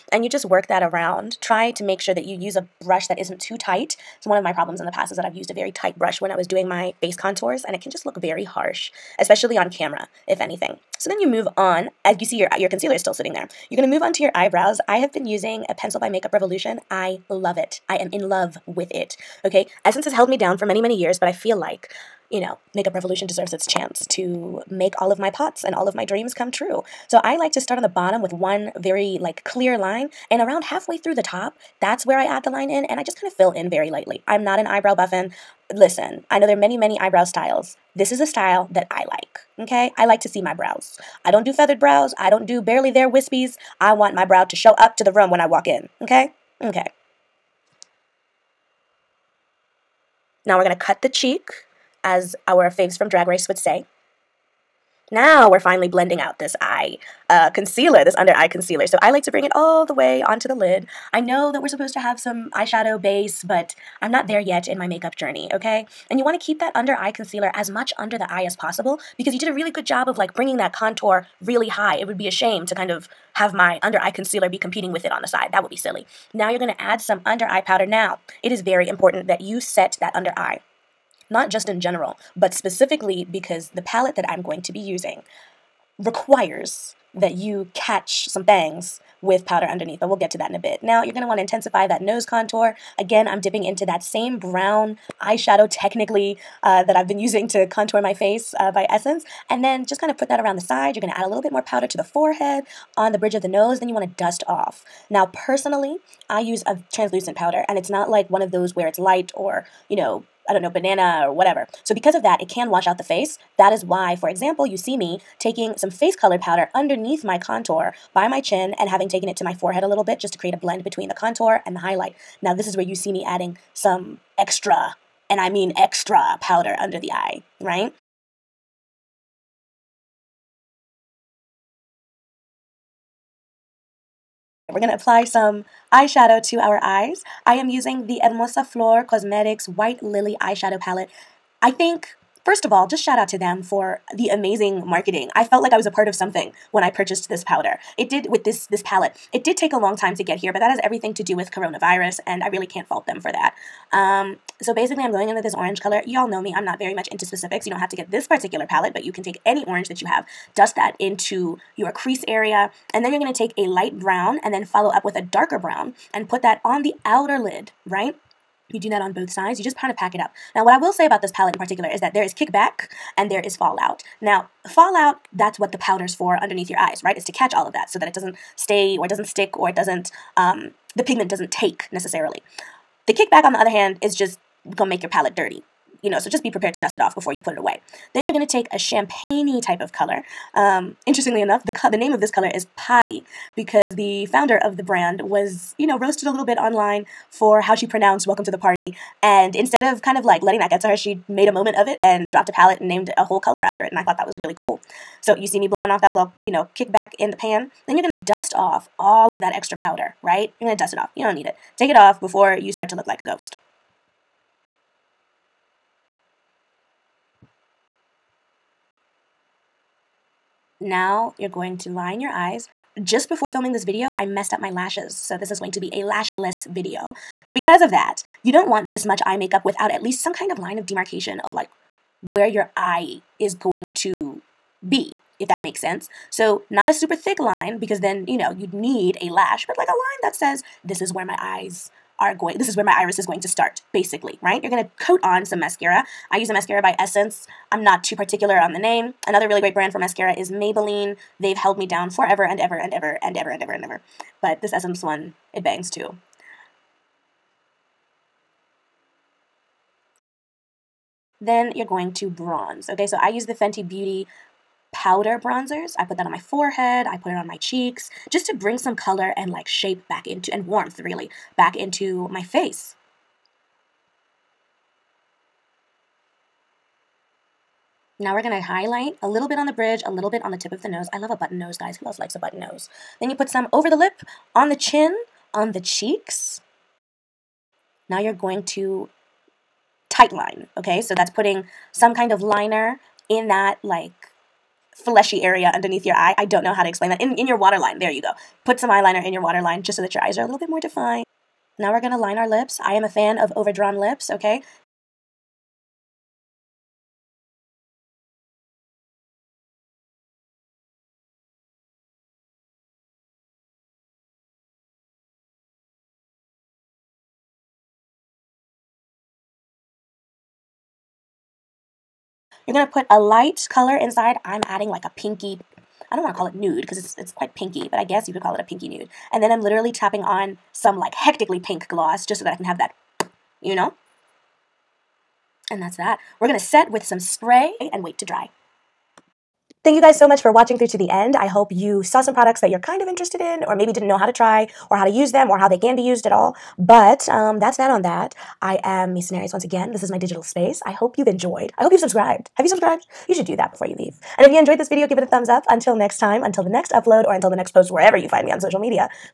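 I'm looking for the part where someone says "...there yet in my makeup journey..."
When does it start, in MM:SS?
01:04.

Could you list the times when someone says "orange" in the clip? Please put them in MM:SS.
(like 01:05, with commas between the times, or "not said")
02:35, 02:39.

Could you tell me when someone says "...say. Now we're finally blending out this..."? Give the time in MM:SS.
00:53.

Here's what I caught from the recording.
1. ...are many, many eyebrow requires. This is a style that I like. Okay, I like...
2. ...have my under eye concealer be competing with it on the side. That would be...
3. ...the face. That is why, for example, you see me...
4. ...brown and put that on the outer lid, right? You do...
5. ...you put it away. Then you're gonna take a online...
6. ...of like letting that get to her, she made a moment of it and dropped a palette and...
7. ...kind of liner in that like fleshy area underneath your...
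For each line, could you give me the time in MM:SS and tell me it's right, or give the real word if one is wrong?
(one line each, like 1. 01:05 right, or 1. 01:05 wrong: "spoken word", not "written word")
1. 00:36 wrong: "styles", not "requires"
2. 01:13 right
3. 01:52 right
4. 02:45 right
5. 03:07 wrong: "champagne", not "online"
6. 03:20 right
7. 04:52 right.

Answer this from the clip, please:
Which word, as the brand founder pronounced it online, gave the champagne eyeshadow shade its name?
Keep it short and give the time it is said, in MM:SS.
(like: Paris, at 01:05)
Potty, at 03:12.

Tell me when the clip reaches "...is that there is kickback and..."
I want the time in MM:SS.
02:51.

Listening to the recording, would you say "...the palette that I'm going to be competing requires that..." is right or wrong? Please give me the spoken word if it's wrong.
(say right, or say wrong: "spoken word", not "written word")
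wrong: "using", not "competing".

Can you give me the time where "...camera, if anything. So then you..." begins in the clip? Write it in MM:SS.
00:09.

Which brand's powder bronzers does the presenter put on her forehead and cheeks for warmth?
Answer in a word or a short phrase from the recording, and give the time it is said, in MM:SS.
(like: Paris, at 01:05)
Fenty Beauty, at 04:23.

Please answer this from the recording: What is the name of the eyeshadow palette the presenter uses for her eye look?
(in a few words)
White Lily.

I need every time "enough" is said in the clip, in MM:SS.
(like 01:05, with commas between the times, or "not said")
03:11.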